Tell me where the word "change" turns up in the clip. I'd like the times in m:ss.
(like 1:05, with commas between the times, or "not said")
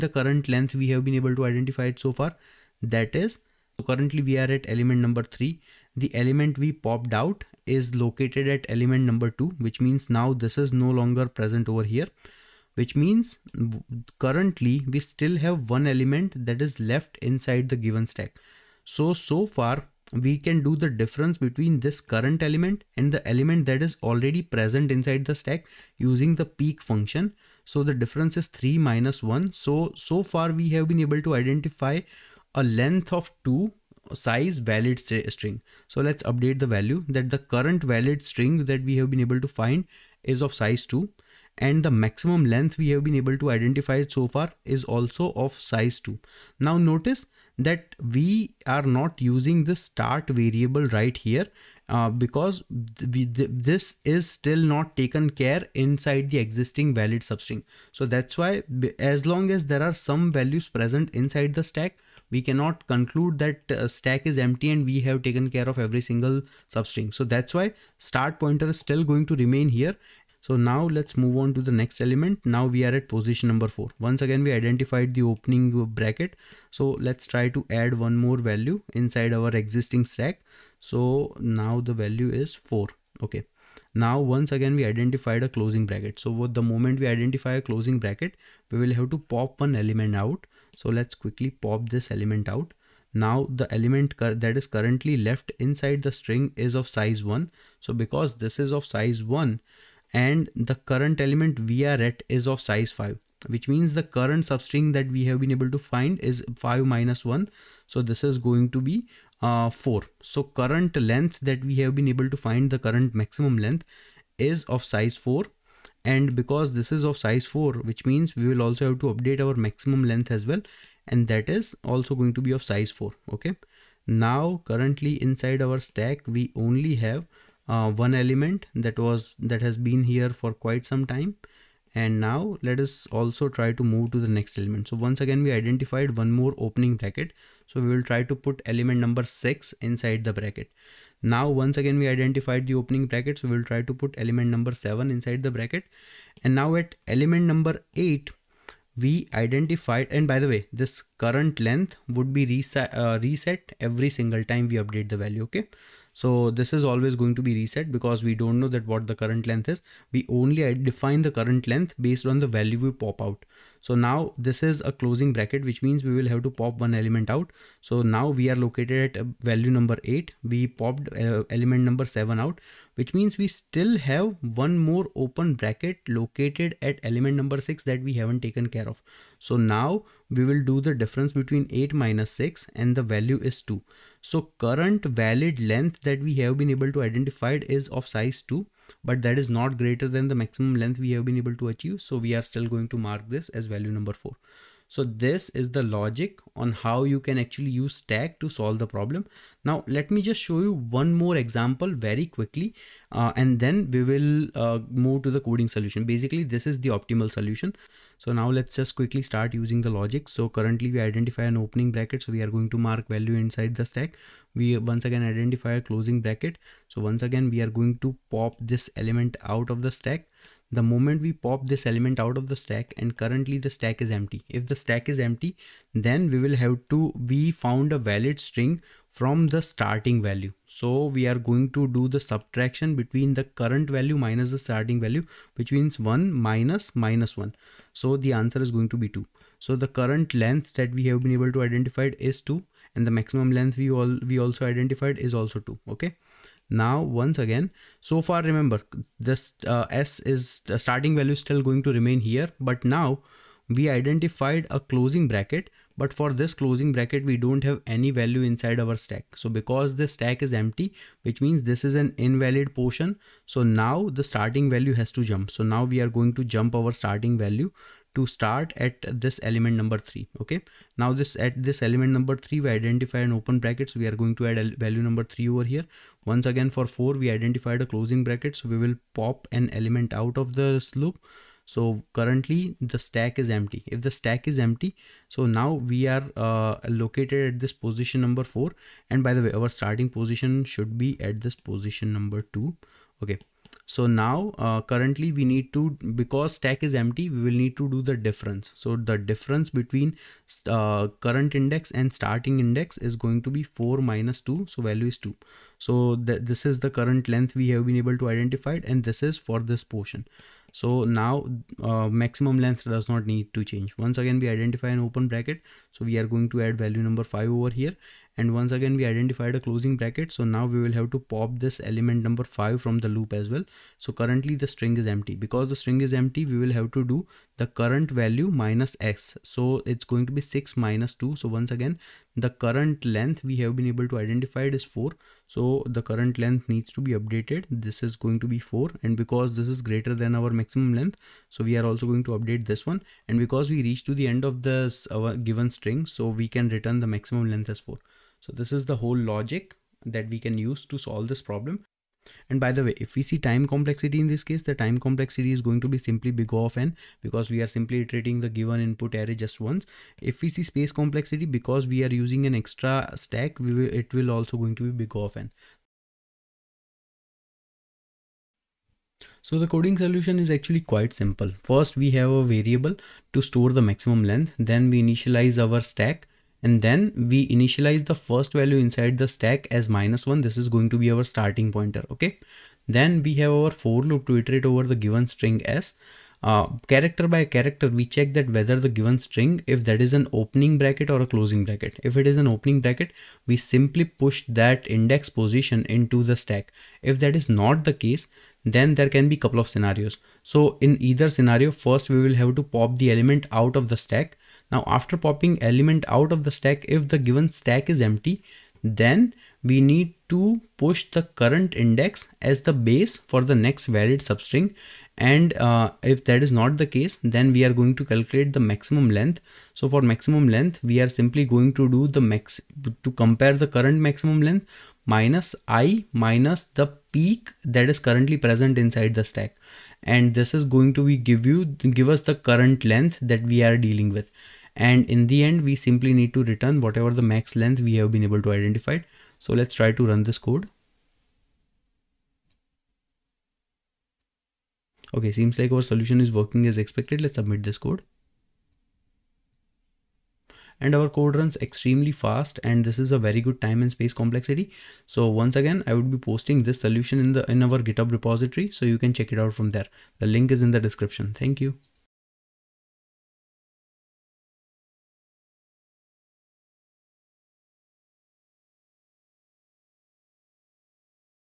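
5:13.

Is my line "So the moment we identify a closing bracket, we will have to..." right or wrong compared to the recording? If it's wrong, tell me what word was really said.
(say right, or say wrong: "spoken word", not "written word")
right.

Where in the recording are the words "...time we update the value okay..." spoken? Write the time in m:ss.
2:34.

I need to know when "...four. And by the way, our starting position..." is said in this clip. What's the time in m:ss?
4:48.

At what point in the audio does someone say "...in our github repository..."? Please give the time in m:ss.
7:37.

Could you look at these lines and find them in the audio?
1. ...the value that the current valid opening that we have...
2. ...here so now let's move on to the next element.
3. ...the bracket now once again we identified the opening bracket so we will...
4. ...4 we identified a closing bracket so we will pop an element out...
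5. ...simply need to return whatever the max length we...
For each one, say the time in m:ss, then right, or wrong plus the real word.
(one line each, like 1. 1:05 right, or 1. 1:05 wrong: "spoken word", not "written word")
1. 0:36 wrong: "string", not "opening"
2. 1:09 right
3. 2:20 right
4. 4:36 right
5. 7:15 right.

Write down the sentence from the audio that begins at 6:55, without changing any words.
And uh, if that is not the case, then we are going to calculate the maximum length.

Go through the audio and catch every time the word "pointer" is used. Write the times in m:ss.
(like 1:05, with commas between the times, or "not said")
1:08, 6:21.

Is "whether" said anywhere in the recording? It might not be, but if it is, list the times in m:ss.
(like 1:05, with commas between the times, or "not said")
6:28.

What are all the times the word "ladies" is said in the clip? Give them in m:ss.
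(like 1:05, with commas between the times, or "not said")
not said.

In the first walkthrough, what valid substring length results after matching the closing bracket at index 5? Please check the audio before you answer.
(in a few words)
4.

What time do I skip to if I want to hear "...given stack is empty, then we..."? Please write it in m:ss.
6:47.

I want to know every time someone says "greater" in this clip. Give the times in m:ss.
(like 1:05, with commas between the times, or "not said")
3:09, 5:39.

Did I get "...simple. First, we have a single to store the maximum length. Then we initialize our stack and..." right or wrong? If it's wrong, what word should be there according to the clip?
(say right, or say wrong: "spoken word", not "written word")
wrong: "variable", not "single".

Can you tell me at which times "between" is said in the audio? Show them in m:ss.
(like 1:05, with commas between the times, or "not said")
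0:21, 3:01, 3:52, 4:59.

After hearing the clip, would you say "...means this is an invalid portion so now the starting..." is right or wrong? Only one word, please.
right.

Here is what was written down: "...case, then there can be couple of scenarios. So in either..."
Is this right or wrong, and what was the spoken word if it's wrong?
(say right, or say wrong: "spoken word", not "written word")
right.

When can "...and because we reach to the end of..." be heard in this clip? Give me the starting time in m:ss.
5:43.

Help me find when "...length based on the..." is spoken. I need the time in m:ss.
2:41.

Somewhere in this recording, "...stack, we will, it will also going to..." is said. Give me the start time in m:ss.
6:03.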